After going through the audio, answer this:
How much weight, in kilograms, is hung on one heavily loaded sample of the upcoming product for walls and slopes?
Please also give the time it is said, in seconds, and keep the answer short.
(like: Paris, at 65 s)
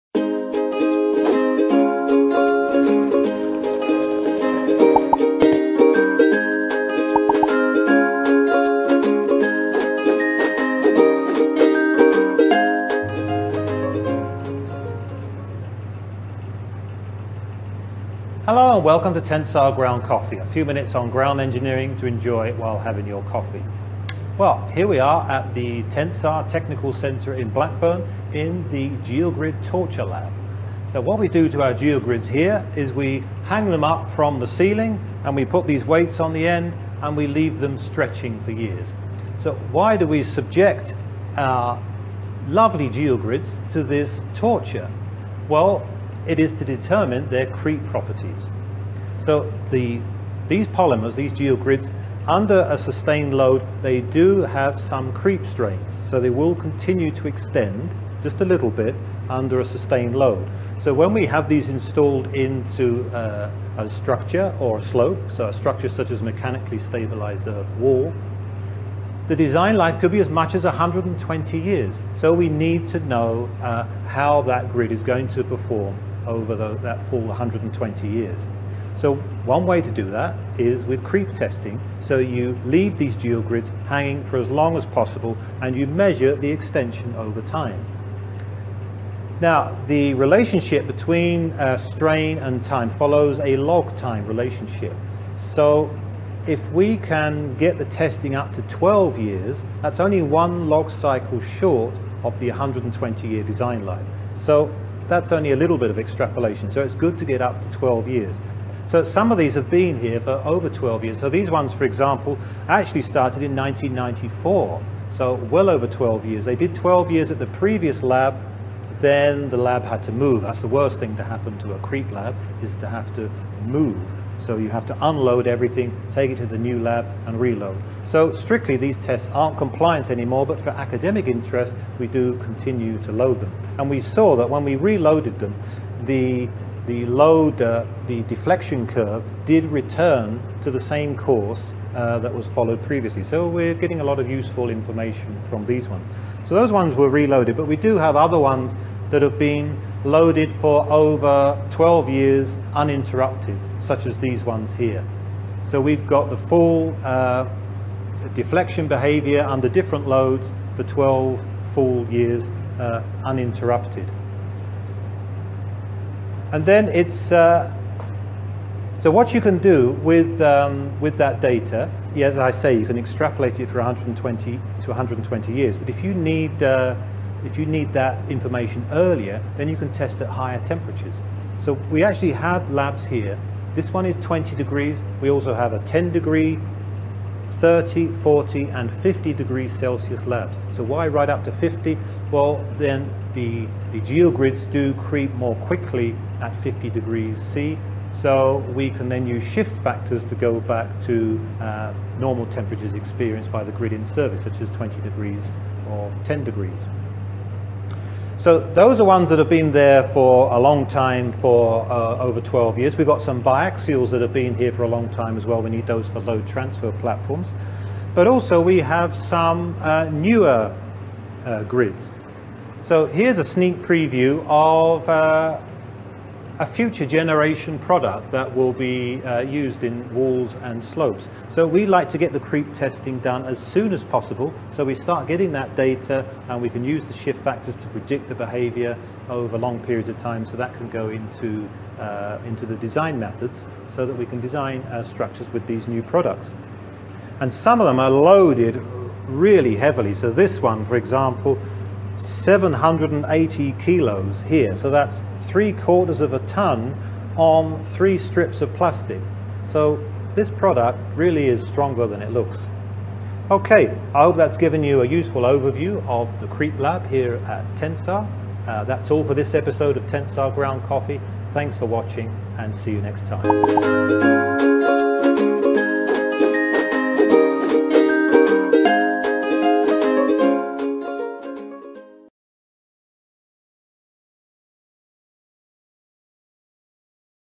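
780, at 252 s.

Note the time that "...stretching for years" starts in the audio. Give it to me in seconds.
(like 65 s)
37 s.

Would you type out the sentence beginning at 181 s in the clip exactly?
So we actually have labs here.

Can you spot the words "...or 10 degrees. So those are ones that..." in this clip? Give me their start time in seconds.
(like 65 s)
205 s.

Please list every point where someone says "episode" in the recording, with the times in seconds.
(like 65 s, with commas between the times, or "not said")
269 s.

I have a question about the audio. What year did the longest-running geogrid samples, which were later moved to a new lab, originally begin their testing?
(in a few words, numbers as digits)
1994.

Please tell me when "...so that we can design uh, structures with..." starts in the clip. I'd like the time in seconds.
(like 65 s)
243 s.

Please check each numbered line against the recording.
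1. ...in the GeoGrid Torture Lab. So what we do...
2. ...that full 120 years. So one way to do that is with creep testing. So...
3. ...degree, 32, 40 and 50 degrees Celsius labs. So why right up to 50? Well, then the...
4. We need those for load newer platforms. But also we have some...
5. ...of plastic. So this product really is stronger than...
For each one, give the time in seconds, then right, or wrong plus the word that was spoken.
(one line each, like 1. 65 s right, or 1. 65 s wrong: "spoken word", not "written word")
1. 28 s right
2. 76 s right
3. 186 s wrong: "30", not "32"
4. 215 s wrong: "transfer", not "newer"
5. 258 s right.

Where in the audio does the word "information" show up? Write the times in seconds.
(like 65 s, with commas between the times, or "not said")
144 s, 178 s.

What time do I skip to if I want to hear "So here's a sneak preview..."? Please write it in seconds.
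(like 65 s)
222 s.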